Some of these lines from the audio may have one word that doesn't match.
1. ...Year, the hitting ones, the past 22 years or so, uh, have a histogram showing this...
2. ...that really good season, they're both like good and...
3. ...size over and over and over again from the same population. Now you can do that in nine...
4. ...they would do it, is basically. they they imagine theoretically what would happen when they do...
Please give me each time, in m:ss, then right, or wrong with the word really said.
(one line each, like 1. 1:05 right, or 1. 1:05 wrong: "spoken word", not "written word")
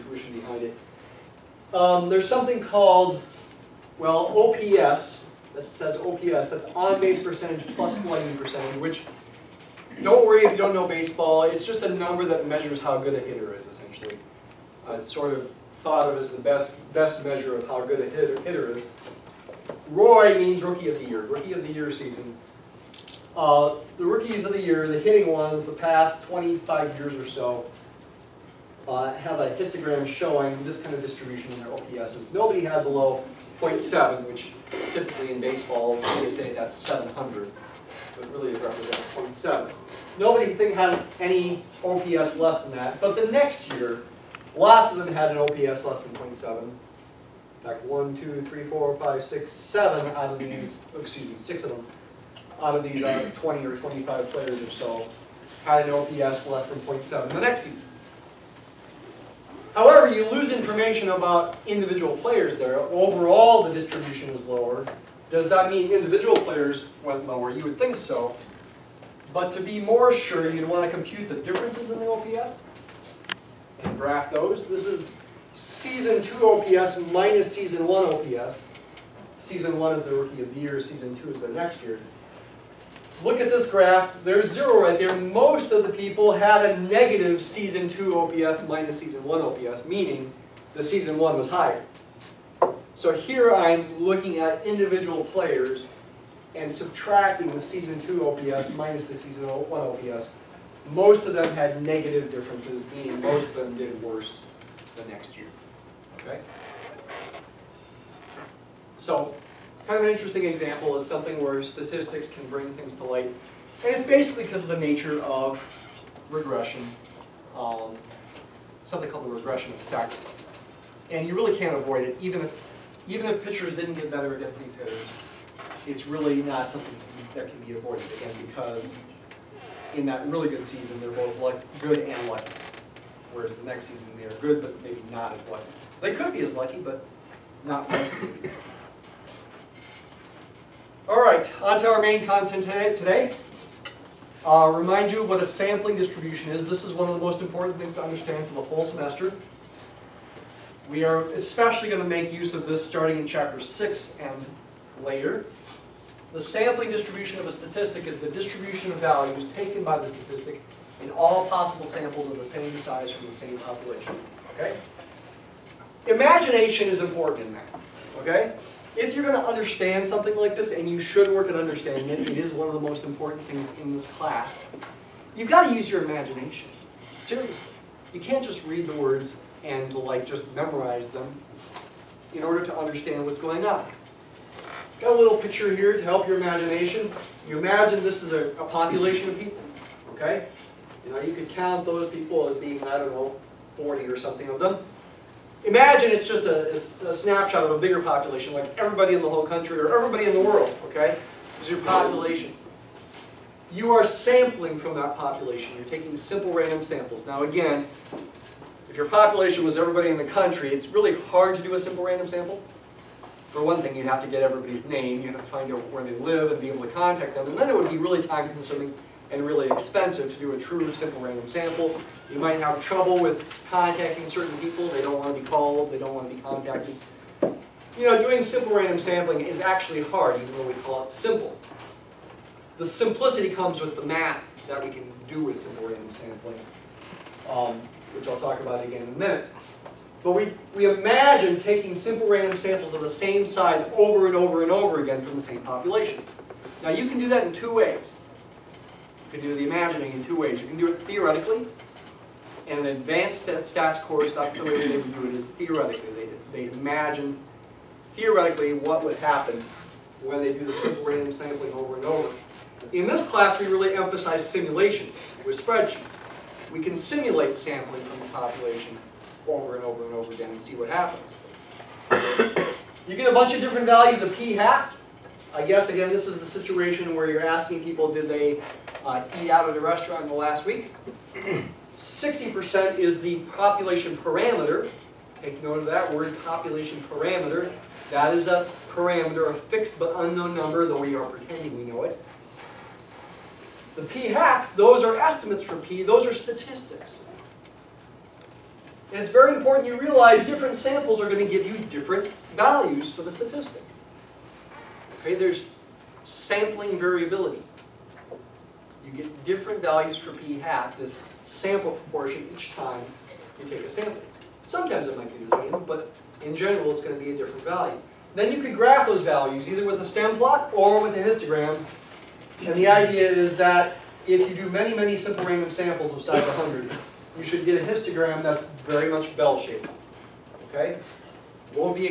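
1. 0:24 wrong: "25", not "22"
2. 2:10 right
3. 4:03 wrong: "two", not "nine"
4. 4:14 wrong: "theoretically", not "basically".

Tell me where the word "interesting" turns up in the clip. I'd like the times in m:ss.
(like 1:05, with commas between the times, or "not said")
1:50.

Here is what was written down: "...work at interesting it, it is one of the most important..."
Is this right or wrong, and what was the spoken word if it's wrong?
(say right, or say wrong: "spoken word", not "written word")
wrong: "understanding", not "interesting".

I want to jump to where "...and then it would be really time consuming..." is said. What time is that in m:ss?
3:37.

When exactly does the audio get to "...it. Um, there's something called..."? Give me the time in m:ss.
0:00.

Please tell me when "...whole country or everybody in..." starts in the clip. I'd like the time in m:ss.
3:19.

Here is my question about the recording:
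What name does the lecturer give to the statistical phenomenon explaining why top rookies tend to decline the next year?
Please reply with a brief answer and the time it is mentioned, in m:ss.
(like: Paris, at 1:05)
regression effect, at 1:59.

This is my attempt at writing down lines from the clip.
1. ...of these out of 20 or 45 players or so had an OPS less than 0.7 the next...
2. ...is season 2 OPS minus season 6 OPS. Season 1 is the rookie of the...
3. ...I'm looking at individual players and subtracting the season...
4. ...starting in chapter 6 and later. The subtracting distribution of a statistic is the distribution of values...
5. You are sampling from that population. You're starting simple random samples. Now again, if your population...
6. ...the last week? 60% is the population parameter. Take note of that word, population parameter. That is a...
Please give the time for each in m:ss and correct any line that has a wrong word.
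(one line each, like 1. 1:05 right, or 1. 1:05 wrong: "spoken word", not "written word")
1. 0:52 wrong: "25", not "45"
2. 1:14 wrong: "1", not "6"
3. 1:33 right
4. 2:32 wrong: "sampling", not "subtracting"
5. 3:23 wrong: "taking", not "starting"
6. 4:40 right.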